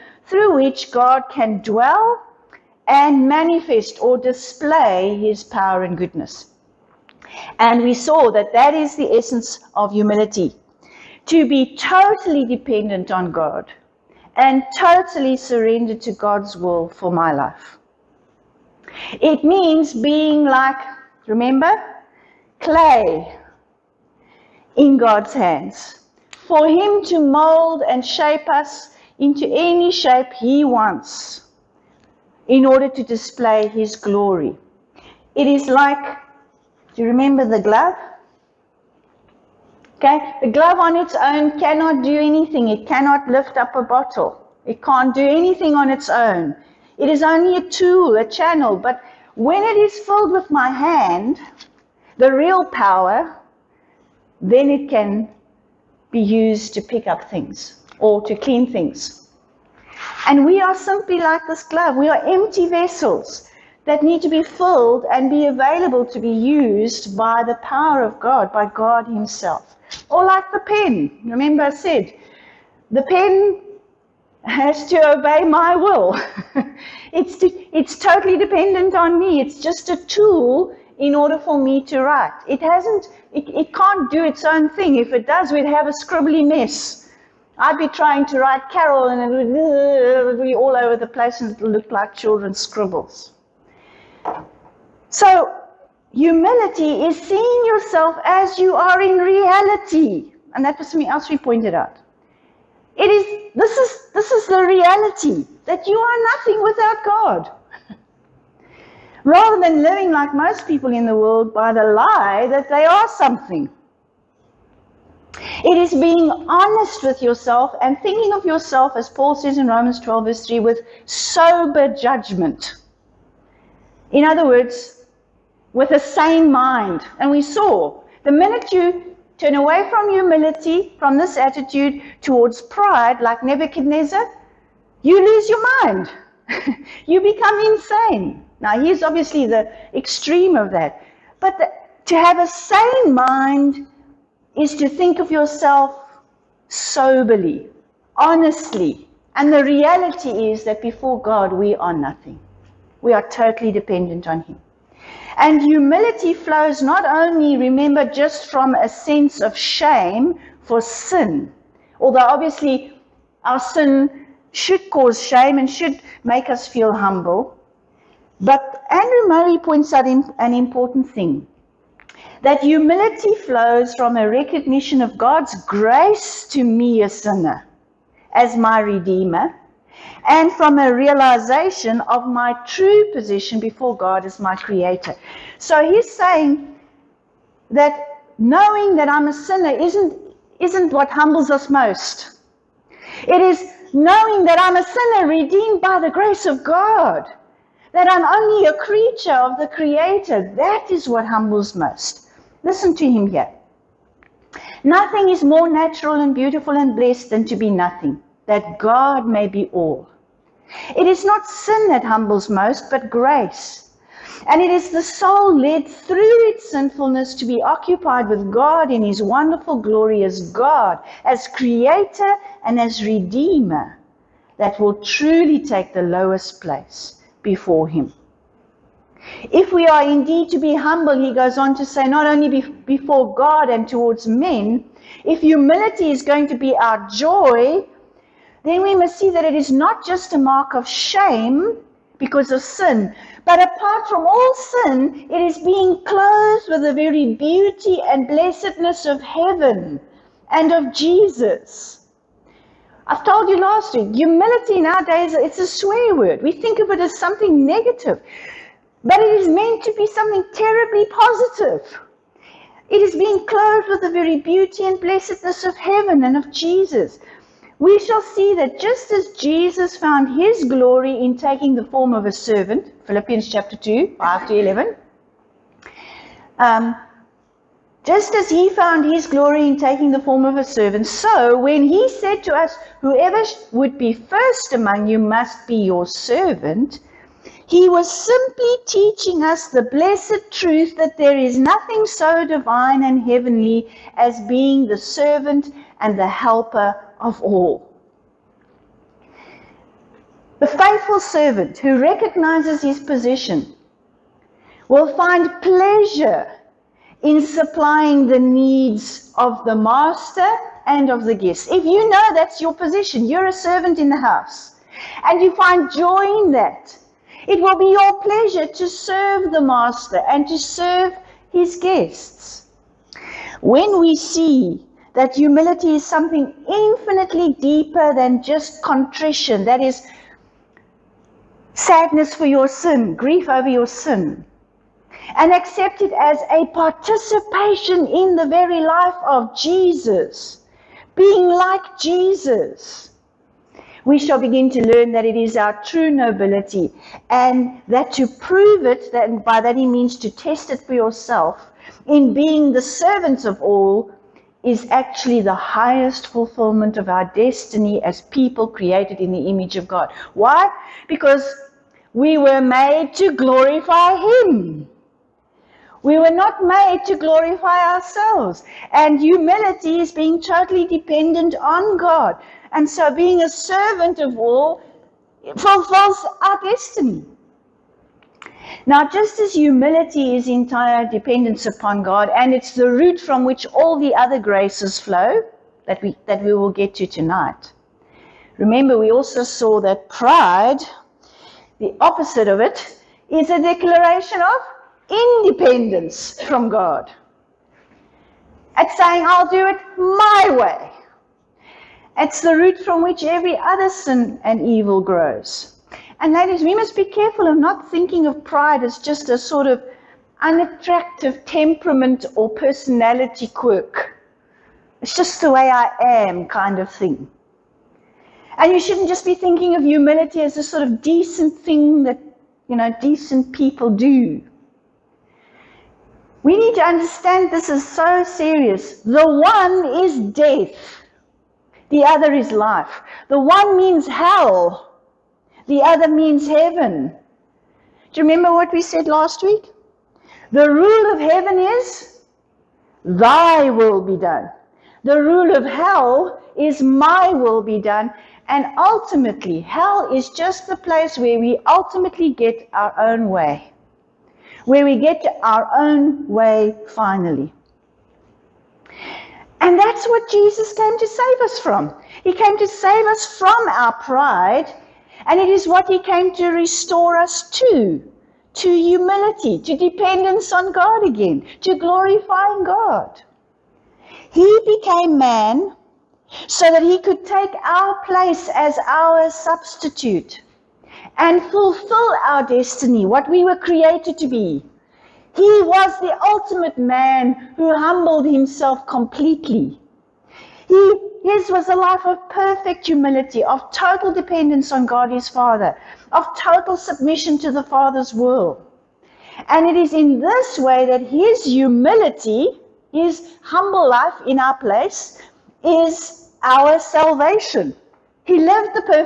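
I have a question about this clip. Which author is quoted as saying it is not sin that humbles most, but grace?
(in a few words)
Andrew Murray.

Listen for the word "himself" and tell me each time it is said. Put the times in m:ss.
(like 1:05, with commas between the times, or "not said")
1:09, 8:08.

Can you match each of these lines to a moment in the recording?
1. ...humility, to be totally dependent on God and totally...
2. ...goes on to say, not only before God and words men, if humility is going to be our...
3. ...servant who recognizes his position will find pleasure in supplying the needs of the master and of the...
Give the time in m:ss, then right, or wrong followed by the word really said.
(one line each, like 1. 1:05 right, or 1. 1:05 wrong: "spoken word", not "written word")
1. 0:09 right
2. 3:51 wrong: "towards", not "words"
3. 5:01 right.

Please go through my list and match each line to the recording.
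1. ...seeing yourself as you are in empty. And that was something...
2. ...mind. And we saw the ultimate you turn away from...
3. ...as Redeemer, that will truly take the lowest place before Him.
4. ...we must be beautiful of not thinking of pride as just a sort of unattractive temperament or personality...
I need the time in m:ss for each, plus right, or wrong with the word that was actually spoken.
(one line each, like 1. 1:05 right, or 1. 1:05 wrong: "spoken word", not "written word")
1. 1:37 wrong: "reality", not "empty"
2. 2:06 wrong: "minute", not "ultimate"
3. 3:42 right
4. 6:46 wrong: "careful", not "beautiful".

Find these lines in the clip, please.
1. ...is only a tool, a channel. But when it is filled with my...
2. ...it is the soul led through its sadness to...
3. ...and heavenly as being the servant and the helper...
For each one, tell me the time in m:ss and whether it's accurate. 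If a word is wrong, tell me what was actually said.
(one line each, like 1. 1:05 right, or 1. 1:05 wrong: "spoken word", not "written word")
1. 0:47 right
2. 3:34 wrong: "sinfulness", not "sadness"
3. 4:53 right.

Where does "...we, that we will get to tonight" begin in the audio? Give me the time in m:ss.
6:26.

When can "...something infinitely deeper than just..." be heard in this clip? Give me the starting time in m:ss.
5:26.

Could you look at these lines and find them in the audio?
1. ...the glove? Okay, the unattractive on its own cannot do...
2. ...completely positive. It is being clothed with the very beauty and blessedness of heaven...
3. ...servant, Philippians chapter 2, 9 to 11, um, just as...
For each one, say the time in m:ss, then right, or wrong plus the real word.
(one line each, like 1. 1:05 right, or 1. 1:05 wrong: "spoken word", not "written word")
1. 0:37 wrong: "glove", not "unattractive"
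2. 4:20 wrong: "terribly", not "completely"
3. 4:32 wrong: "5", not "9".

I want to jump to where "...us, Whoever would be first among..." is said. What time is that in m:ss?
4:42.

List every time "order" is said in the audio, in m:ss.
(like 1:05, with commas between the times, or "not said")
0:32, 1:21.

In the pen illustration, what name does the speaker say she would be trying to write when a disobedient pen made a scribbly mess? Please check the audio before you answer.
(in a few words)
Carol.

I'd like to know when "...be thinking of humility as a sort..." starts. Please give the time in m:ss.
6:59.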